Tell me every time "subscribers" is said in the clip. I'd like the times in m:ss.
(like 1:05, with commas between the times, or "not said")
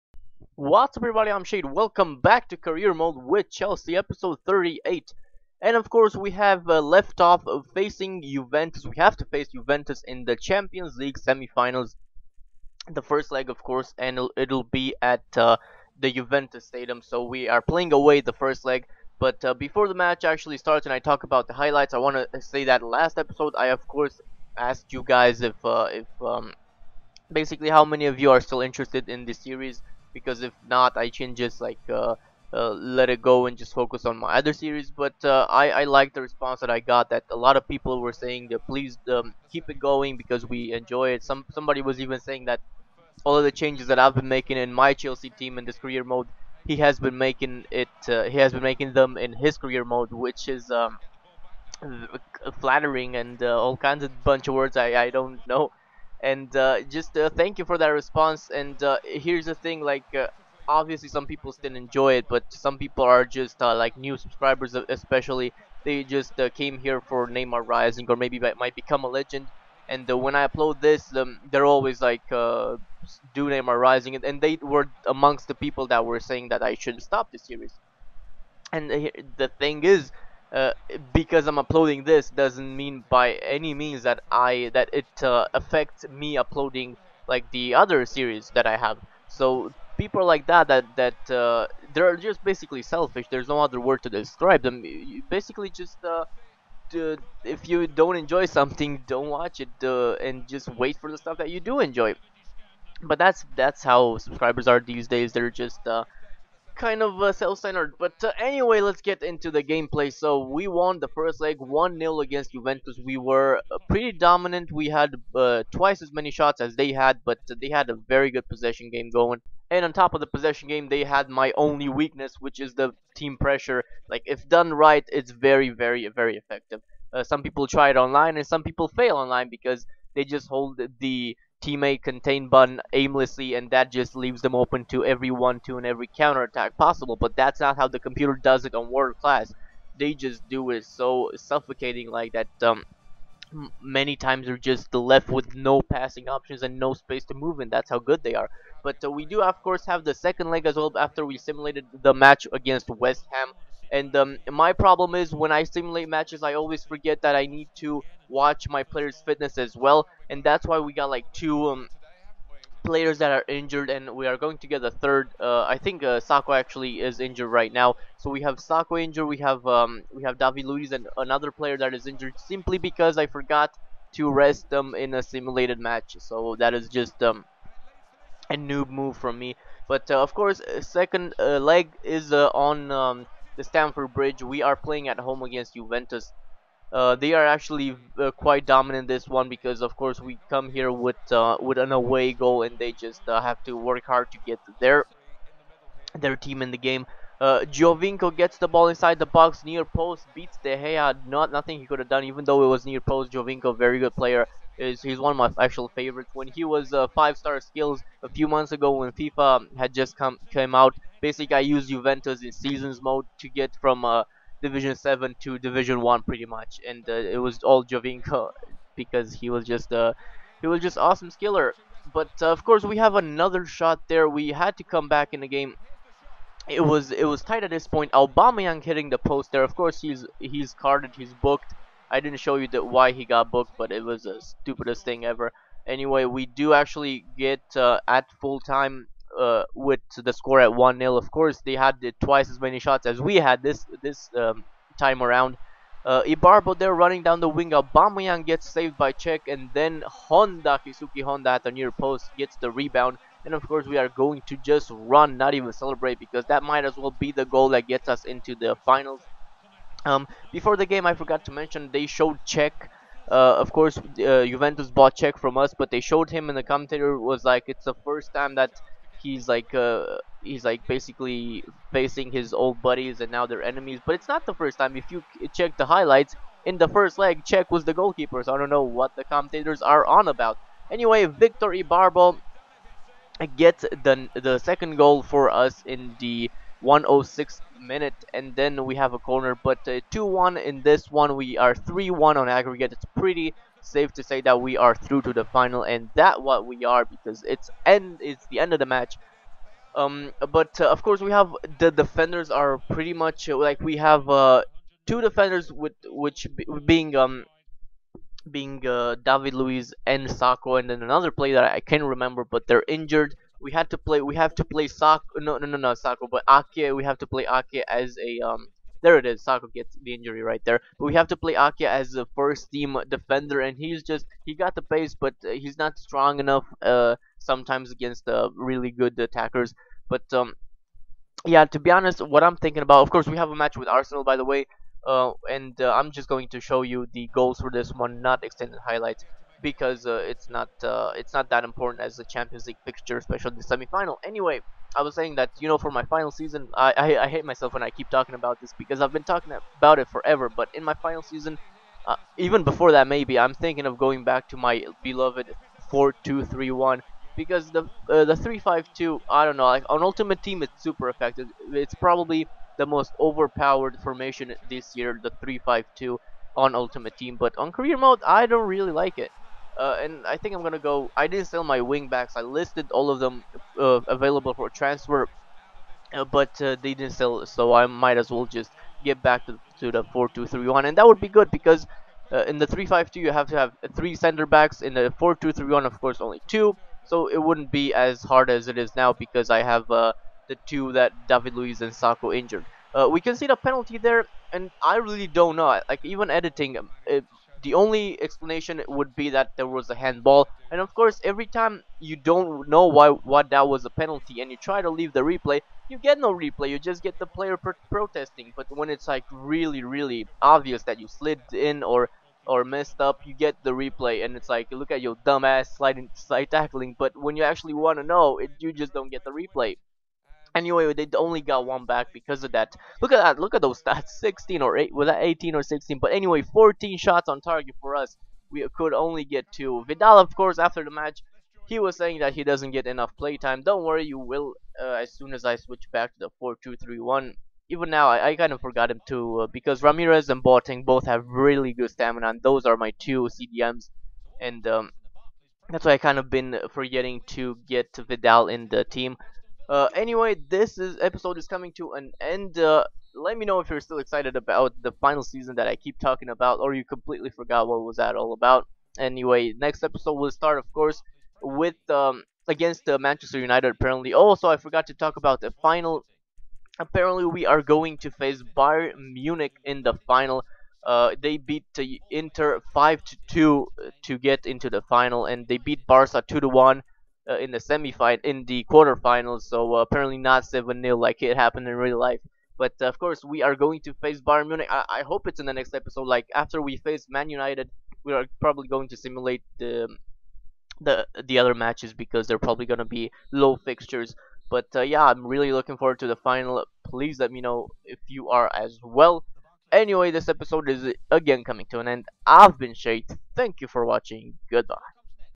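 1:04, 1:44.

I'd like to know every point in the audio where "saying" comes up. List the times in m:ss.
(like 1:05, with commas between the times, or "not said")
0:38, 0:42, 1:16, 5:45, 7:11.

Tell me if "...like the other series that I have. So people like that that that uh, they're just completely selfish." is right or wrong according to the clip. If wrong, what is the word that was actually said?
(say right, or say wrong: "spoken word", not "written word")
wrong: "basically", not "completely".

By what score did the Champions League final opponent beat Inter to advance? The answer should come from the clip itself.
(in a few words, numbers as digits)
5-2.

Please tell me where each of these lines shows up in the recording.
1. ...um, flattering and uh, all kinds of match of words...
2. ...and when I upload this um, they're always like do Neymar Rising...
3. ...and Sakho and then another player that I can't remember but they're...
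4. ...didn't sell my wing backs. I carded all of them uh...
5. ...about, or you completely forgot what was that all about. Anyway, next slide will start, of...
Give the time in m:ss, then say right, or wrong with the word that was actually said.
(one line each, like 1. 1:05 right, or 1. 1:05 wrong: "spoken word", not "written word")
1. 0:50 wrong: "bunch", not "match"
2. 1:09 right
3. 5:10 right
4. 6:11 wrong: "listed", not "carded"
5. 7:36 wrong: "episode", not "slide".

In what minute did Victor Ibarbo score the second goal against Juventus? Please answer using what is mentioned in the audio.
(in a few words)
106.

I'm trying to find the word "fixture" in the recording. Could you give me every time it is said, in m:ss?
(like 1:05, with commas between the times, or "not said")
5:42, 8:13.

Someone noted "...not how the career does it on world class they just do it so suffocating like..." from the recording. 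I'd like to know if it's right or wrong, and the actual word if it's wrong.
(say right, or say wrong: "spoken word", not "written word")
wrong: "computer", not "career".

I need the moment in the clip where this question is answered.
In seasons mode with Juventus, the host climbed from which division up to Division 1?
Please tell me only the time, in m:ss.
3:34.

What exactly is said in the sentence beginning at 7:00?
Anyway, they only got one back because of that.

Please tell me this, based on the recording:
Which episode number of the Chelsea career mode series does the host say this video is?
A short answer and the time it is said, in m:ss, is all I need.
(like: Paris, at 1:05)
38, at 0:03.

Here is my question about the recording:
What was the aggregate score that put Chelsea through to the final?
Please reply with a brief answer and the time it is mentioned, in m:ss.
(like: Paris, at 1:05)
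3-1, at 4:51.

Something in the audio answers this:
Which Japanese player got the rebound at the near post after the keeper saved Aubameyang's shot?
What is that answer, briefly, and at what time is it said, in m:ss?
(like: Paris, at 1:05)
Keisuke Honda, at 4:10.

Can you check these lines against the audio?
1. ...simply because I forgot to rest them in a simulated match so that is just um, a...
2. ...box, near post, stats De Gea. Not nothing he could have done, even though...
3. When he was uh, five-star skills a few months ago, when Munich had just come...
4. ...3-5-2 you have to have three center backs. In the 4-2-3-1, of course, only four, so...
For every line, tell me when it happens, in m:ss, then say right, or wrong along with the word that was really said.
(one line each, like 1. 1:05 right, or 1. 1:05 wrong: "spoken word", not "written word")
1. 2:52 right
2. 3:19 wrong: "beats", not "stats"
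3. 3:26 wrong: "FIFA", not "Munich"
4. 6:22 wrong: "two", not "four".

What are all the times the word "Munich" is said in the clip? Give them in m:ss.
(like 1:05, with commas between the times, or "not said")
7:49, 8:04.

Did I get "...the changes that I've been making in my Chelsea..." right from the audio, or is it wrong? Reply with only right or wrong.
right.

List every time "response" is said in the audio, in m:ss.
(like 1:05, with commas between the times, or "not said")
0:36, 0:57.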